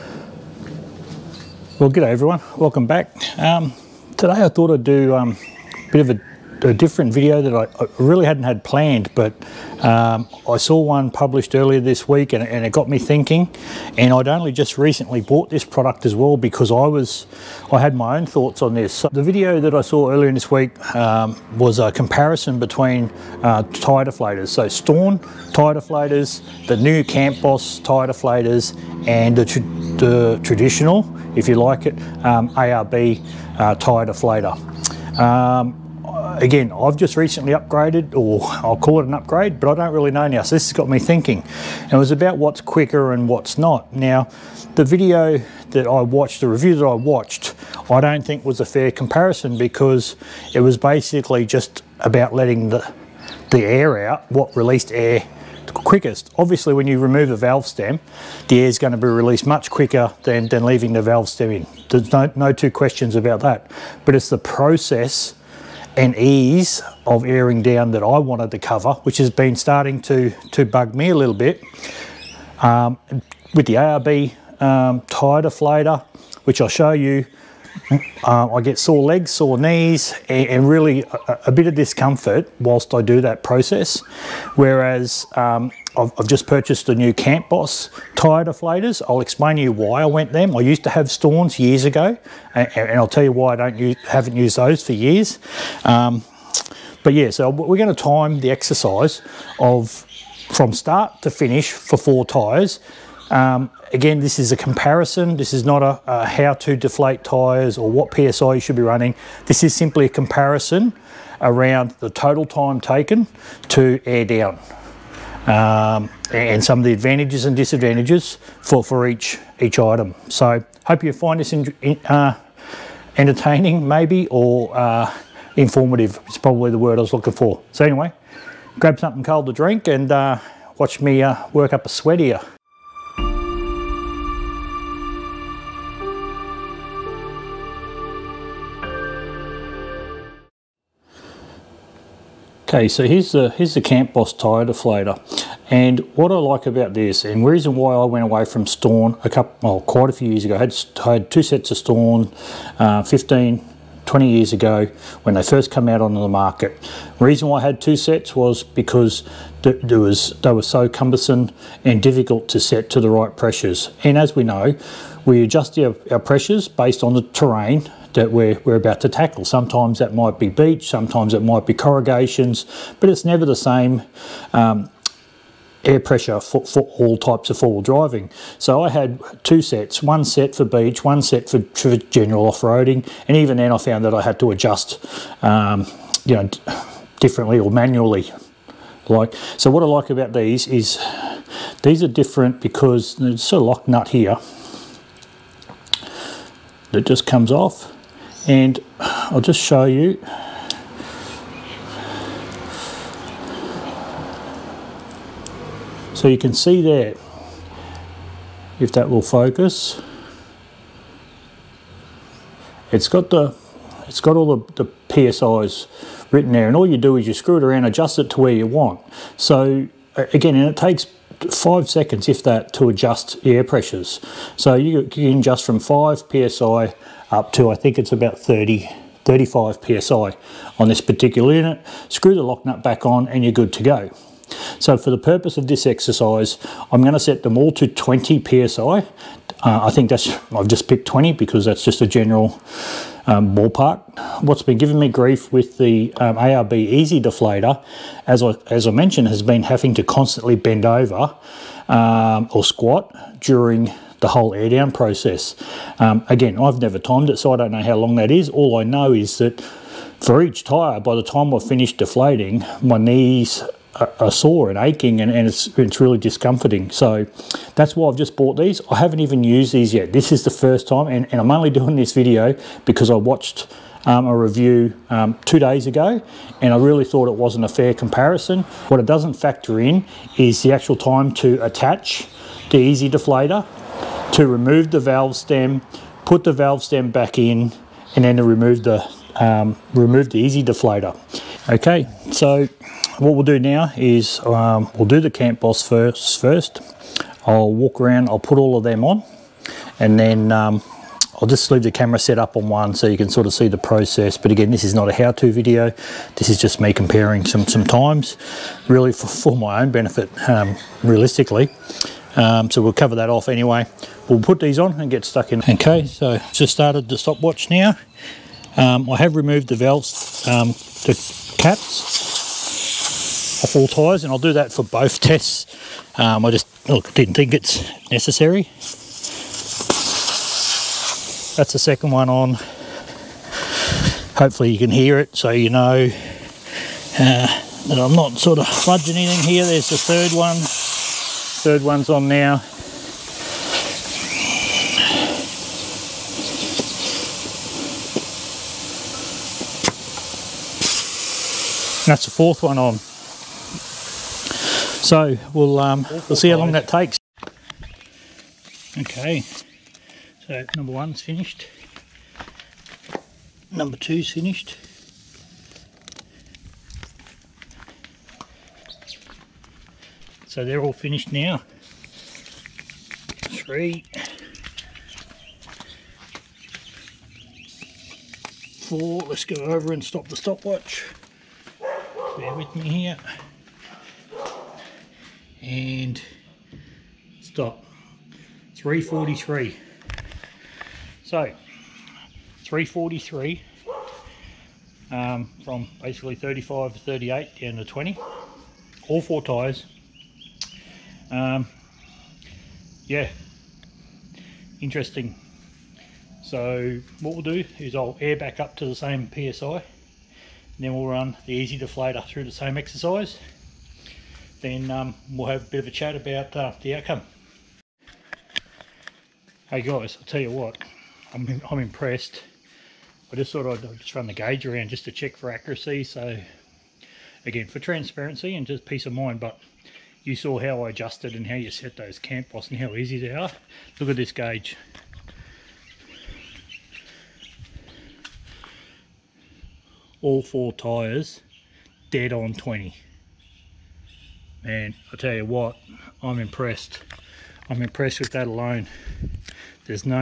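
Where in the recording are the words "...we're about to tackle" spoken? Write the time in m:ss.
2:48.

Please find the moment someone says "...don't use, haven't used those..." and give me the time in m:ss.
1:33.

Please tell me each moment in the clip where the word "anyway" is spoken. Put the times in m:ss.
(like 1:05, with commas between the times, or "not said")
2:07, 5:13.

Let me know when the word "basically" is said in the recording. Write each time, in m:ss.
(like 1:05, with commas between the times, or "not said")
0:50, 6:36.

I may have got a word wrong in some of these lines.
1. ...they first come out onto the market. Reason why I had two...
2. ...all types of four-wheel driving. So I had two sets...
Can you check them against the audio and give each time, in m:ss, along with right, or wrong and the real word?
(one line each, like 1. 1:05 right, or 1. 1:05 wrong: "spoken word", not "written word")
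1. 2:35 right
2. 2:56 right.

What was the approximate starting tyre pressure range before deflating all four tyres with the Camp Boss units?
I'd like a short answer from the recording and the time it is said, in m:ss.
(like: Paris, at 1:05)
35 to 38 psi, at 6:36.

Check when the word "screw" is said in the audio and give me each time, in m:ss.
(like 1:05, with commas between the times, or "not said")
3:37, 3:52.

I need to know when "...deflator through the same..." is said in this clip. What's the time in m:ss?
6:51.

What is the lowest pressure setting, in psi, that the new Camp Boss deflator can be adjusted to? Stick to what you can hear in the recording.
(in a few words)
5 psi.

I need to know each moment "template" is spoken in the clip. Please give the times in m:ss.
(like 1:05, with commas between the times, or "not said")
not said.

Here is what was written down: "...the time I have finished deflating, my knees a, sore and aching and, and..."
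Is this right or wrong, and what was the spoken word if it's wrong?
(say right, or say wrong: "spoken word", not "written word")
right.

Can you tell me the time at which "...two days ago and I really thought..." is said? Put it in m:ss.
4:35.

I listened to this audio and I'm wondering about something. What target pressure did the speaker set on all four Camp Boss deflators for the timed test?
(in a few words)
20 psi.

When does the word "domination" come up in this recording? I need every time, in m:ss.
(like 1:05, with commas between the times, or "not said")
not said.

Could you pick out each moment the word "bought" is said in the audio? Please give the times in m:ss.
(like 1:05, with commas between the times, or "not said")
0:15, 4:28.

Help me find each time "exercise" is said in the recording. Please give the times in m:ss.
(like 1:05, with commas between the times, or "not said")
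1:38, 3:55, 6:52.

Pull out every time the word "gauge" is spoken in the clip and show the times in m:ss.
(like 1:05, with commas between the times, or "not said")
7:04, 7:14.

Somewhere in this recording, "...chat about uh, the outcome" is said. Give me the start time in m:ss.
6:55.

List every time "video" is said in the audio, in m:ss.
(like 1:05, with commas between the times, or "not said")
0:07, 0:19, 0:44, 4:32, 5:05.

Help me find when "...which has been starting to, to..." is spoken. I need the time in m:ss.
1:09.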